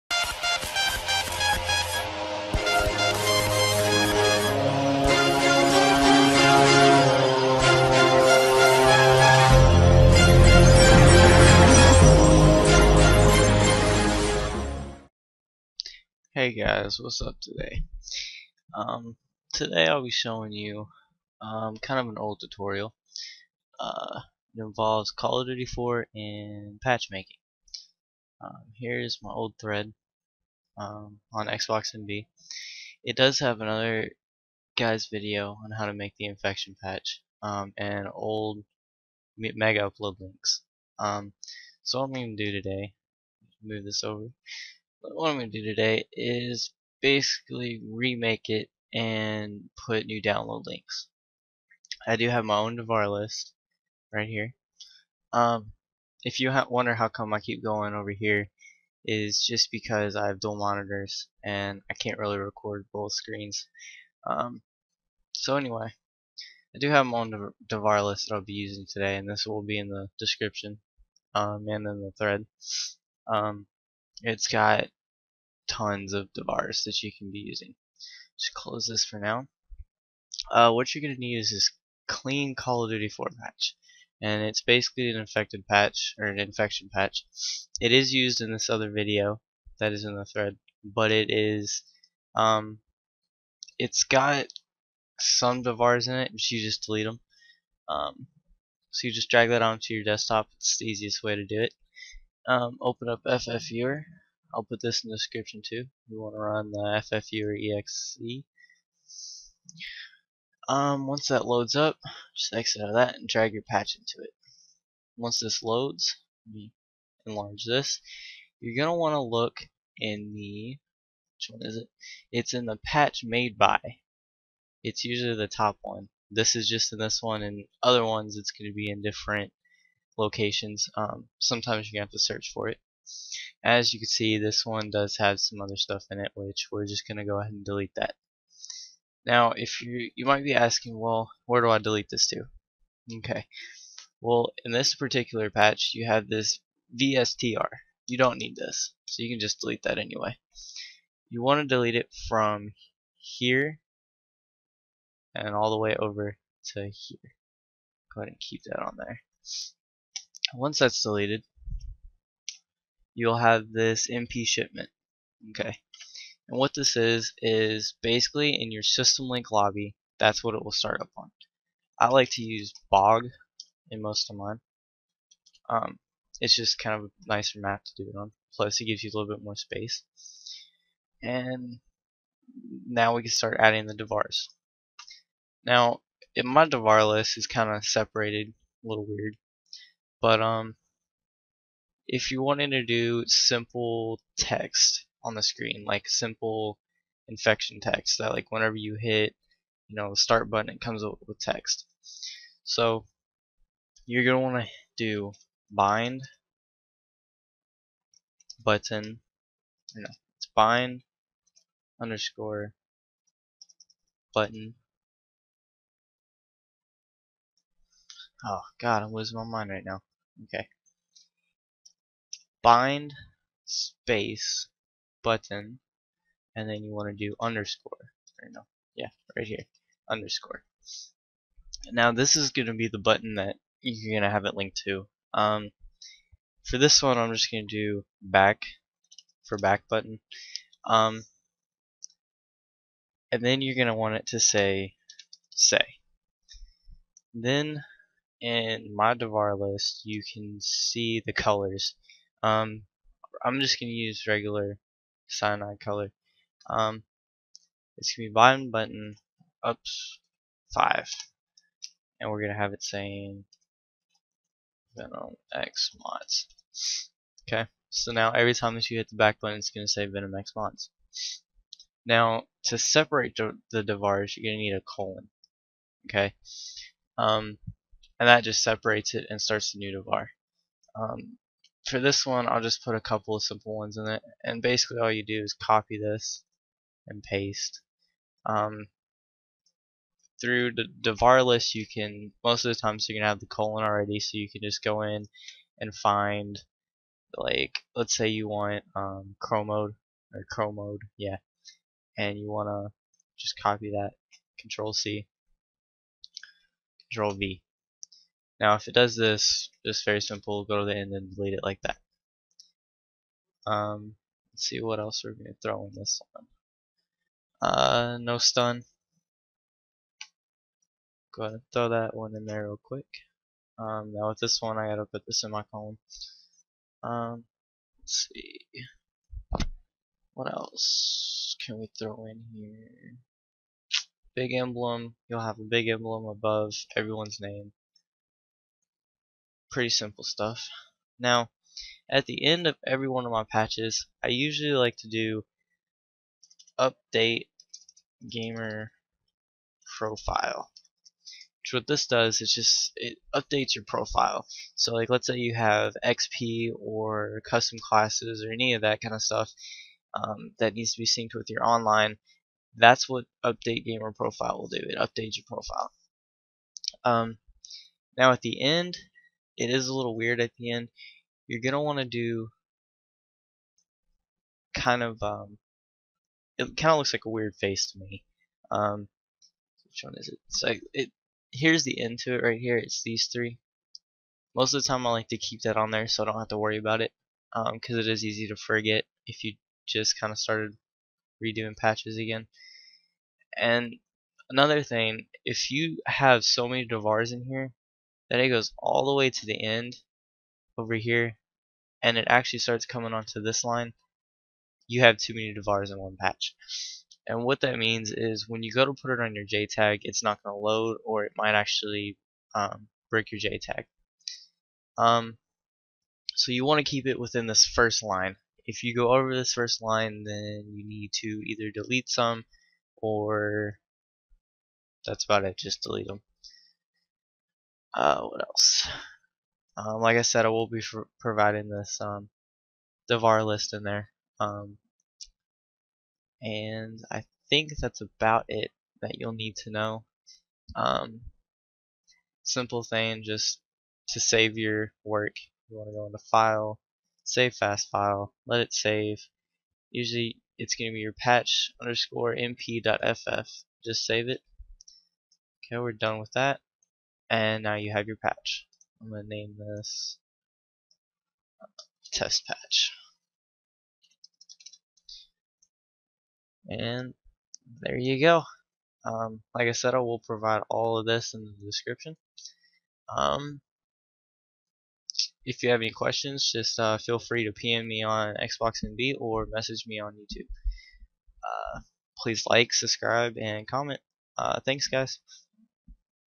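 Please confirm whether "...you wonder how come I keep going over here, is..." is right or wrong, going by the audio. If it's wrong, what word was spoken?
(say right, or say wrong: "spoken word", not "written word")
right.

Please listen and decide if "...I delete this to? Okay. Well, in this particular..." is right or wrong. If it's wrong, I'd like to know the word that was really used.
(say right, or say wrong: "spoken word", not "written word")
right.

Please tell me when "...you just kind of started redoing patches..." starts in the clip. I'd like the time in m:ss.
6:29.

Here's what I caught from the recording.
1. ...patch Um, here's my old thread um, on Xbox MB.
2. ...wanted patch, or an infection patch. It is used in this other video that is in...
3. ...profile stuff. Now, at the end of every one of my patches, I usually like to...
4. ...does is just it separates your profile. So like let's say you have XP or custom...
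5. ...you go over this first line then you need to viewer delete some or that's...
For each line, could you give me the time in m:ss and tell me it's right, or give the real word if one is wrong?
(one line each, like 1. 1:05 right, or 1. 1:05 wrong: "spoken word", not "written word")
1. 0:26 right
2. 1:25 wrong: "infected", not "wanted"
3. 5:39 wrong: "simple", not "profile"
4. 5:52 wrong: "updates", not "separates"
5. 6:58 wrong: "either", not "viewer".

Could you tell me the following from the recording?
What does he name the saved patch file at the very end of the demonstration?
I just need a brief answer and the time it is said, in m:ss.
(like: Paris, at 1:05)
test patch, at 7:42.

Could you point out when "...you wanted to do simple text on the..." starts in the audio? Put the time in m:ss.
3:12.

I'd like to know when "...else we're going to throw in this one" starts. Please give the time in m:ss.
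5:14.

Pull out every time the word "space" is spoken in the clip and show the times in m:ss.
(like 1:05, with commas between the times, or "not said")
2:59, 3:43.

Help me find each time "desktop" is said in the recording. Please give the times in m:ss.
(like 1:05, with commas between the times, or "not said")
1:40.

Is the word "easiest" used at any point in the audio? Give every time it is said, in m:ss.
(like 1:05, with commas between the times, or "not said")
1:40.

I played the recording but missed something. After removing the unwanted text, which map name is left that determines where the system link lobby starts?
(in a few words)
MP shipment.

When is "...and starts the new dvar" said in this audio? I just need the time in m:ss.
4:39.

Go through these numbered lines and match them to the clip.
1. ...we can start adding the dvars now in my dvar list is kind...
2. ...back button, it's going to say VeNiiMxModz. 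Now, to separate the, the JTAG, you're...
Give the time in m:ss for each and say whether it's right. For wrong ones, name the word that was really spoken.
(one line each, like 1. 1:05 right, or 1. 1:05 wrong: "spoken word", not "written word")
1. 3:03 right
2. 4:29 wrong: "Dvars", not "JTAG".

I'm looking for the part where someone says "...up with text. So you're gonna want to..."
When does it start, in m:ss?
3:21.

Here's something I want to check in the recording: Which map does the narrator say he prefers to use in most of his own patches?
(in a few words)
Bog.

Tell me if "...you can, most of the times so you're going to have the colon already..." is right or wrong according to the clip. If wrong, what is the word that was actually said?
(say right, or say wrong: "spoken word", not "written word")
right.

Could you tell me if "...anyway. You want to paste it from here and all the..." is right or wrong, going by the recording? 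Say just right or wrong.
wrong.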